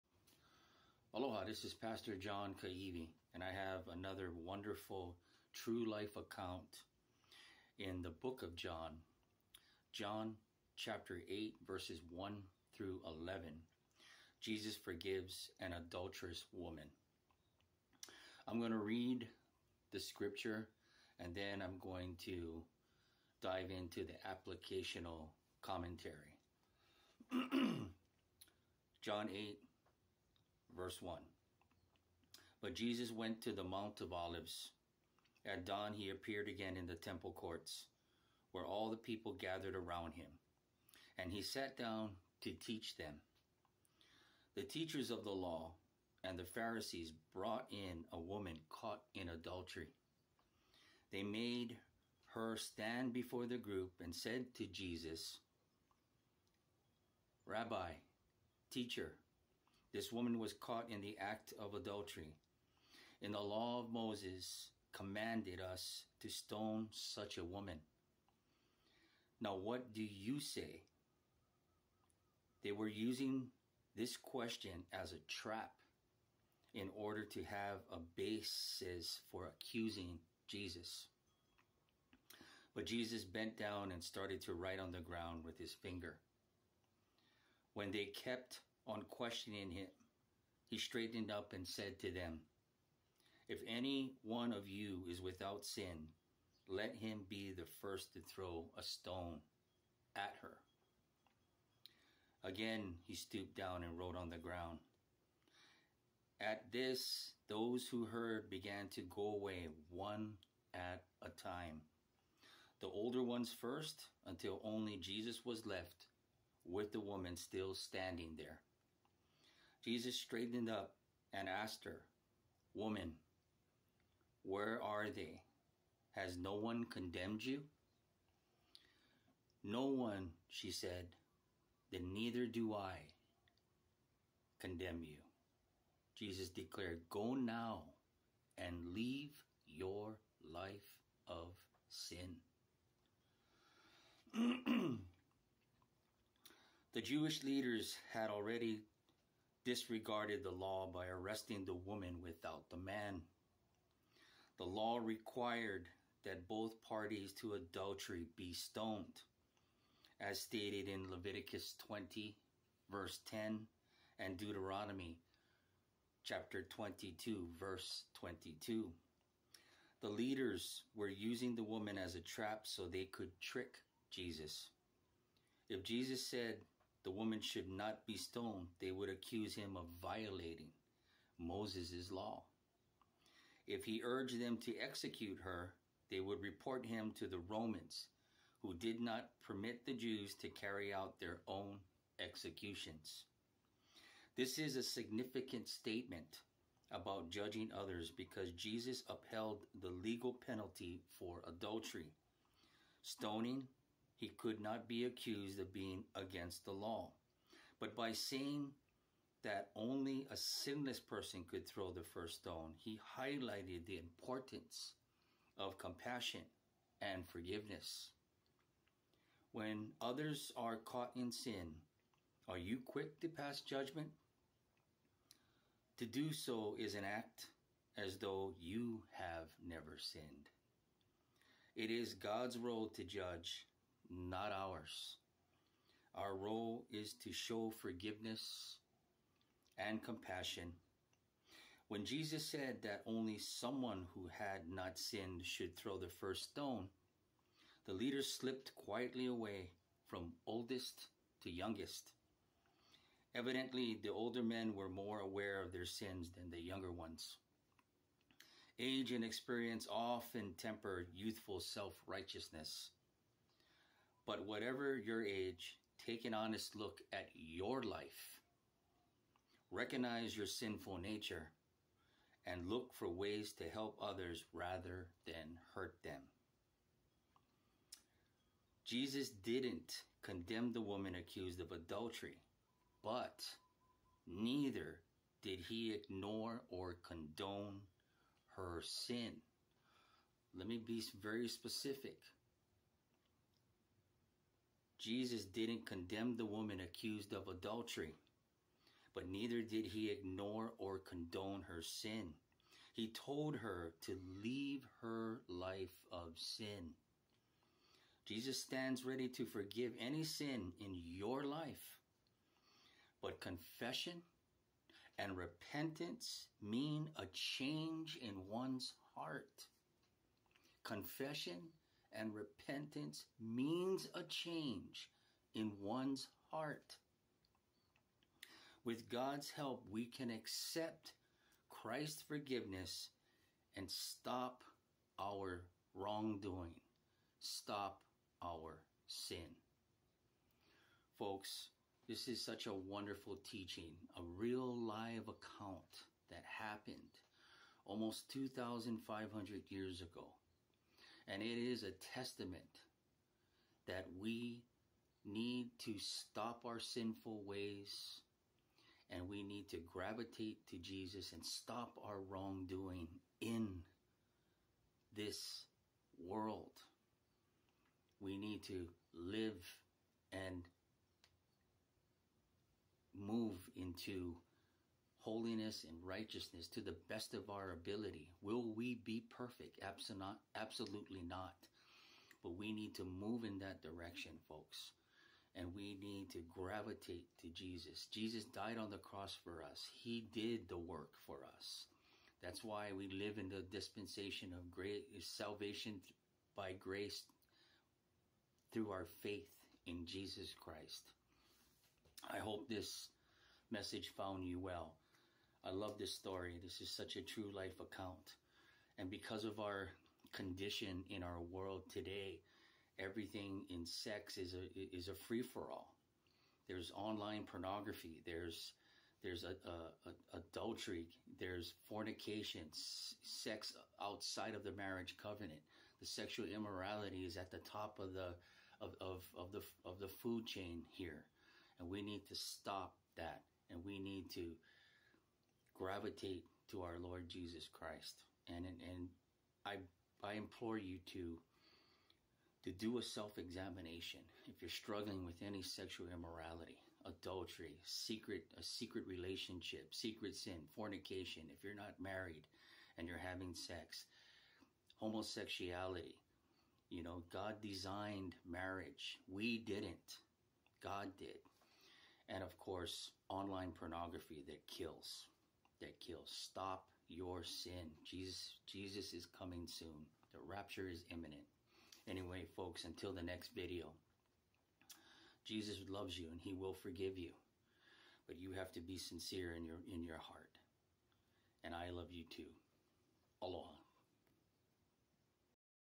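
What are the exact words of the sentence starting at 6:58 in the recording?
There's there's a, a, a adultery.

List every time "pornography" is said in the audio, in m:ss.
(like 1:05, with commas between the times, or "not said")
6:57, 7:43.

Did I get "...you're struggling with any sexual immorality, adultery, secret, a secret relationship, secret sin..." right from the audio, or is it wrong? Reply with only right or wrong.
right.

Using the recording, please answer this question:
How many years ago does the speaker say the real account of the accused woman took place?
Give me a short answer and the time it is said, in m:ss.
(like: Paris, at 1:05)
2,500, at 5:48.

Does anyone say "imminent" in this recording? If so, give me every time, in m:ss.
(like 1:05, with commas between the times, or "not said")
7:51.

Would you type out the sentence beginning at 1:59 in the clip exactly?
Jesus straightened up and asked her, Woman, where are they?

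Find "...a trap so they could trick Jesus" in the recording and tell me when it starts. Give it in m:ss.
2:52.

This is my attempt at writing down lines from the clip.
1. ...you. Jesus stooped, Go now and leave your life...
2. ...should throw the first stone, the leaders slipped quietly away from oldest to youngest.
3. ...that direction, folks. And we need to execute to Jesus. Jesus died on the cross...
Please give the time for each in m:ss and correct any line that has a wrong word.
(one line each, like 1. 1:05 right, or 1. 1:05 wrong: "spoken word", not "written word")
1. 2:15 wrong: "declared", not "stooped"
2. 4:05 right
3. 6:23 wrong: "gravitate", not "execute".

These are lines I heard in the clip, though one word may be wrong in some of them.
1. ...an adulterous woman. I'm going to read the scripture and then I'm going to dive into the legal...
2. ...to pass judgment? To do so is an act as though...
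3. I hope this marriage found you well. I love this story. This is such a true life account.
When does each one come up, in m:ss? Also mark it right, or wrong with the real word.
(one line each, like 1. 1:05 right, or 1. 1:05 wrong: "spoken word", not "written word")
1. 0:15 wrong: "applicational", not "legal"
2. 3:43 right
3. 6:42 wrong: "message", not "marriage".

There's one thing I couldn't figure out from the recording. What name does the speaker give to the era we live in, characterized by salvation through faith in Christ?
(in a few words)
Dispensation of grace.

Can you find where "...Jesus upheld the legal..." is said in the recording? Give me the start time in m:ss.
3:18.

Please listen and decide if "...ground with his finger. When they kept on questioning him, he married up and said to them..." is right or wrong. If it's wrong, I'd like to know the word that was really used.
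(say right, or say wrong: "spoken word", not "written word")
wrong: "straightened", not "married".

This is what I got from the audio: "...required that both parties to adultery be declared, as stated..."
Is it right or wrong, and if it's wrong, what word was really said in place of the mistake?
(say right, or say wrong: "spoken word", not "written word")
wrong: "stoned", not "declared".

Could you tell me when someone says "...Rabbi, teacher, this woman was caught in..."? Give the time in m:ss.
0:57.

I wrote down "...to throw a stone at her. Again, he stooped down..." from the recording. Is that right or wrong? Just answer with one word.
right.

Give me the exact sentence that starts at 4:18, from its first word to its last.
Age and experience often temper youthful self righteousness but whatever your age, take an honest look at your life.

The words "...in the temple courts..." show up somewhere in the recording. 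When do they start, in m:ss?
0:36.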